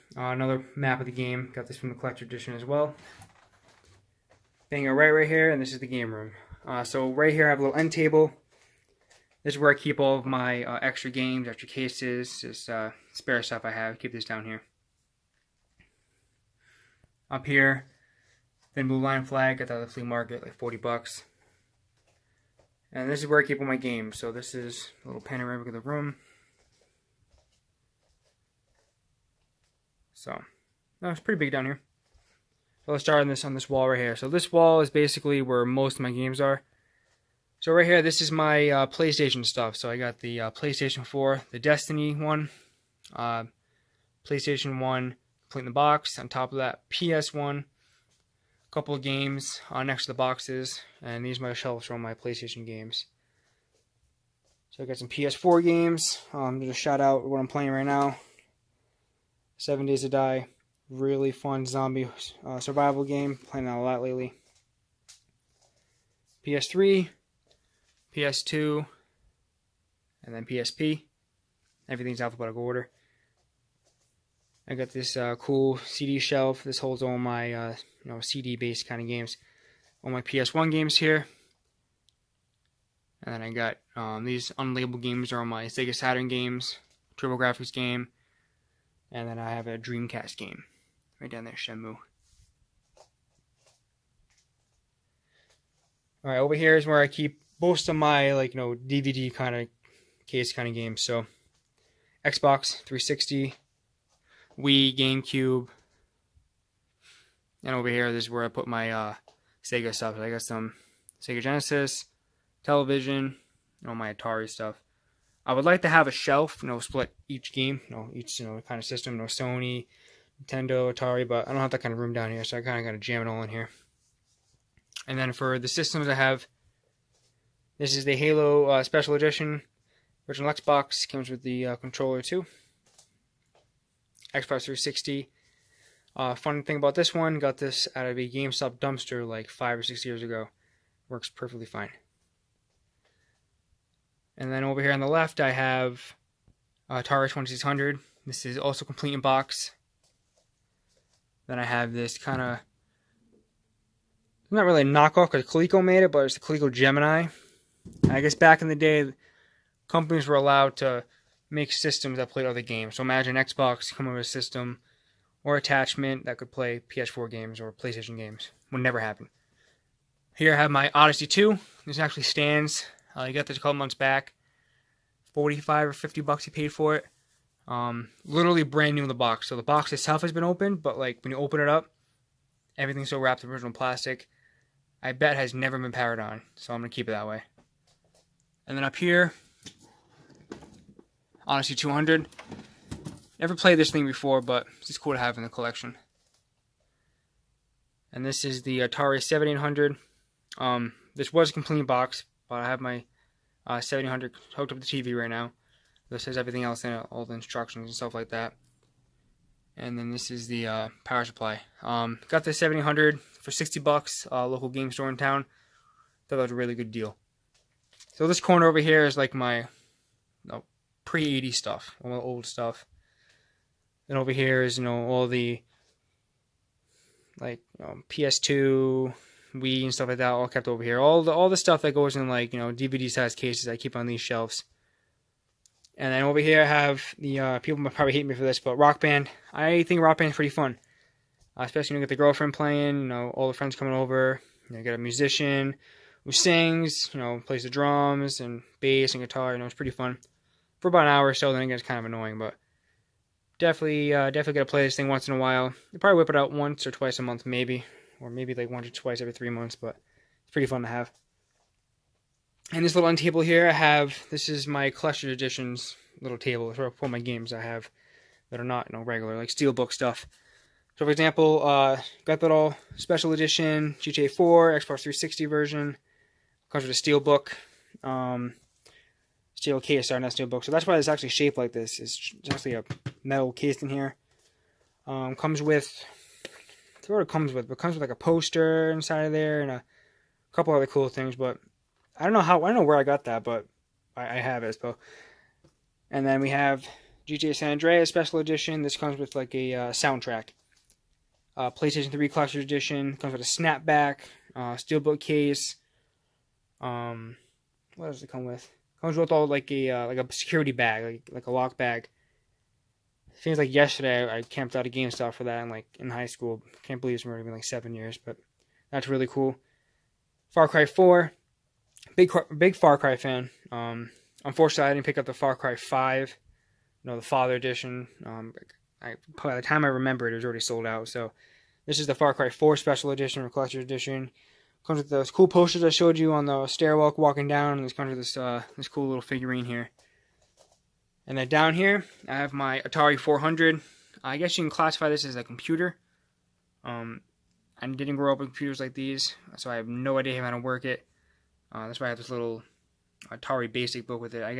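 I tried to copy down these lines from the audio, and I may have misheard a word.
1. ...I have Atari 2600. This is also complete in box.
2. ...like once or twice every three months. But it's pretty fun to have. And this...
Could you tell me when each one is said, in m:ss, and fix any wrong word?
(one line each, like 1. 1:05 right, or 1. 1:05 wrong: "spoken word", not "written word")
1. 2:25 right
2. 4:18 right.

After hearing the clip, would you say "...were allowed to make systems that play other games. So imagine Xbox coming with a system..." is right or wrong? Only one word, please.
right.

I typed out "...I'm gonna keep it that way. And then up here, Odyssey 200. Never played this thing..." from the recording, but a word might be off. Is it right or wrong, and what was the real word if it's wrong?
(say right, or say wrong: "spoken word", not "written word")
right.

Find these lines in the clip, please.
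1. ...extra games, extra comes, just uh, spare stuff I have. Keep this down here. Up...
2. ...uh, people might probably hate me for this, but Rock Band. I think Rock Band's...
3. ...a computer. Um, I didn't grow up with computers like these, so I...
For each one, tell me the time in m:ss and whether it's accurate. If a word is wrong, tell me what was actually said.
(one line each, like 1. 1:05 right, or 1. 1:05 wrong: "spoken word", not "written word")
1. 0:10 wrong: "cases", not "comes"
2. 3:57 right
3. 5:45 right.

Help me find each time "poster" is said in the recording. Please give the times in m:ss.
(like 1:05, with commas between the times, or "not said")
4:48, 5:35.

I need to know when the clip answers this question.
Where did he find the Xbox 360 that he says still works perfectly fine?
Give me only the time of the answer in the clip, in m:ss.
2:18.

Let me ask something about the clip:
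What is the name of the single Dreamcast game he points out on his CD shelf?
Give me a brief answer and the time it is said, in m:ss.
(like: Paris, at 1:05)
Shenmue, at 1:31.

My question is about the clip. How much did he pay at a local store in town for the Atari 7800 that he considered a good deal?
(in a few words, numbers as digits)
$60.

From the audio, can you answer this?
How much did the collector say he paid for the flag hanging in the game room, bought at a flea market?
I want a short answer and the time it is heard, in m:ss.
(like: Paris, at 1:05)
$40, at 0:20.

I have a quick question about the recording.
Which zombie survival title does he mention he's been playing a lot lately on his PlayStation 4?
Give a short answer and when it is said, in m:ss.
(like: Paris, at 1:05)
Seven Days to Die, at 0:59.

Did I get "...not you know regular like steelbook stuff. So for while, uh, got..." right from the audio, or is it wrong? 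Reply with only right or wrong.
wrong.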